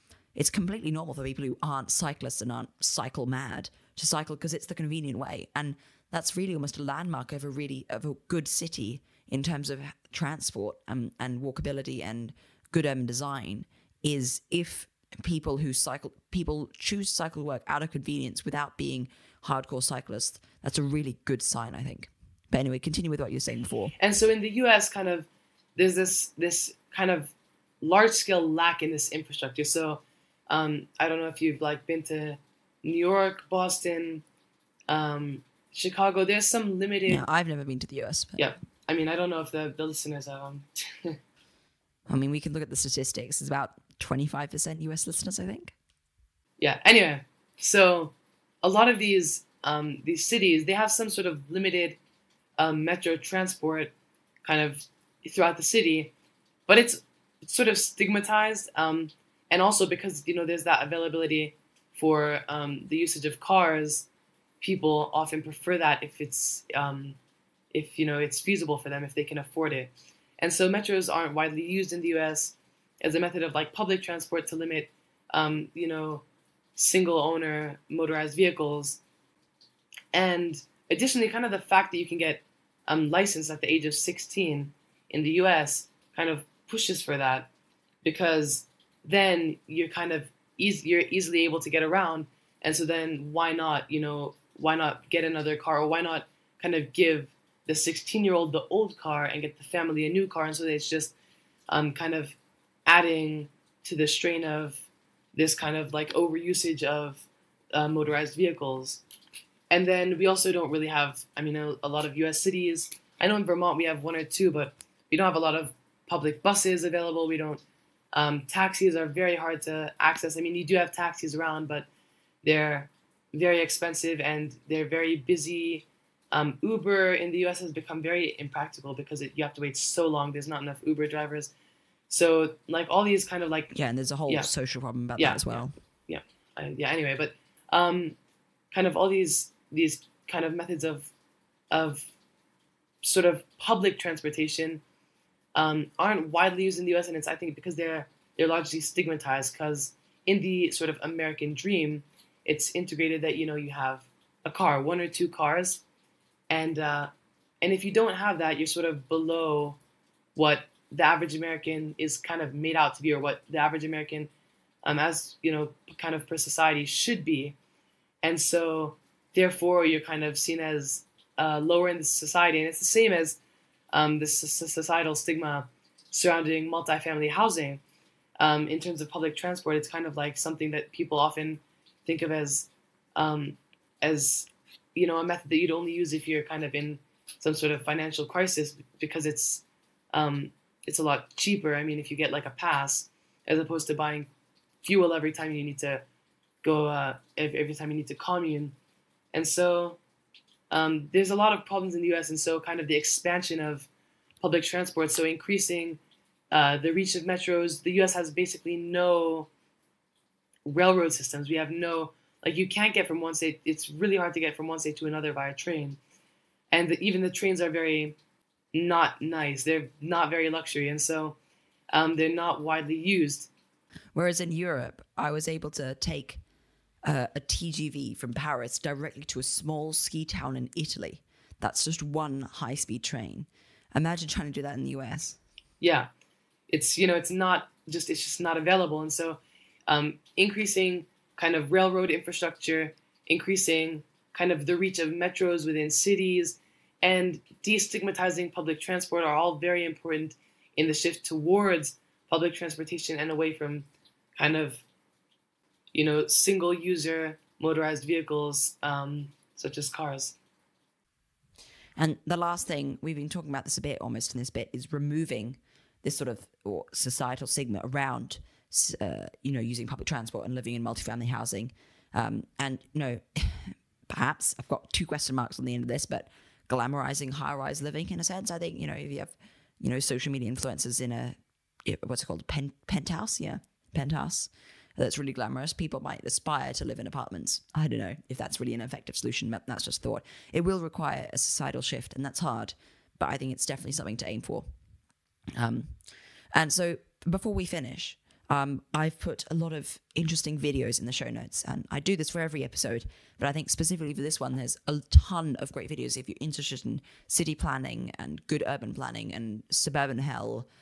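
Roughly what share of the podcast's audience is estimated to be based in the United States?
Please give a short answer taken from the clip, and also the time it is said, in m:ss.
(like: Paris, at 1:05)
25%, at 0:43.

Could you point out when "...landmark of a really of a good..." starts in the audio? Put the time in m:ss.
0:06.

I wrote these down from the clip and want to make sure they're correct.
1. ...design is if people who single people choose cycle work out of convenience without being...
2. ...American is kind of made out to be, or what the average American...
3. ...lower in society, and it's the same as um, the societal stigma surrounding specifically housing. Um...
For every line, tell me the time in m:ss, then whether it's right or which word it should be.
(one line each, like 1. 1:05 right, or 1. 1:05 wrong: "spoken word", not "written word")
1. 0:13 wrong: "cycle", not "single"
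2. 2:41 right
3. 2:51 wrong: "multifamily", not "specifically".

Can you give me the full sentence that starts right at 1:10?
And so metros aren't widely used in the U.S.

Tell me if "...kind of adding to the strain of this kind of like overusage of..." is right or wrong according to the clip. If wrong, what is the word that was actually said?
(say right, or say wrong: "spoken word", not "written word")
right.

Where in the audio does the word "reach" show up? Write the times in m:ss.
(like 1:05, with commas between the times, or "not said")
3:26, 4:04.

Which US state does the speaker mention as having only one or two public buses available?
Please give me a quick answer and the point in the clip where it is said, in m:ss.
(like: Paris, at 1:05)
Vermont, at 1:53.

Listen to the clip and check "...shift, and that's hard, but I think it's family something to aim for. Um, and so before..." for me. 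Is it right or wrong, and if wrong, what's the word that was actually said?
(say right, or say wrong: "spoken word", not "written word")
wrong: "definitely", not "family".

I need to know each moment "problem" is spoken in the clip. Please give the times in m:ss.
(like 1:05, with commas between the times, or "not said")
2:14, 3:21.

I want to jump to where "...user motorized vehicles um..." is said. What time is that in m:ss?
4:16.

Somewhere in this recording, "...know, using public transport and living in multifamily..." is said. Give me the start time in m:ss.
4:29.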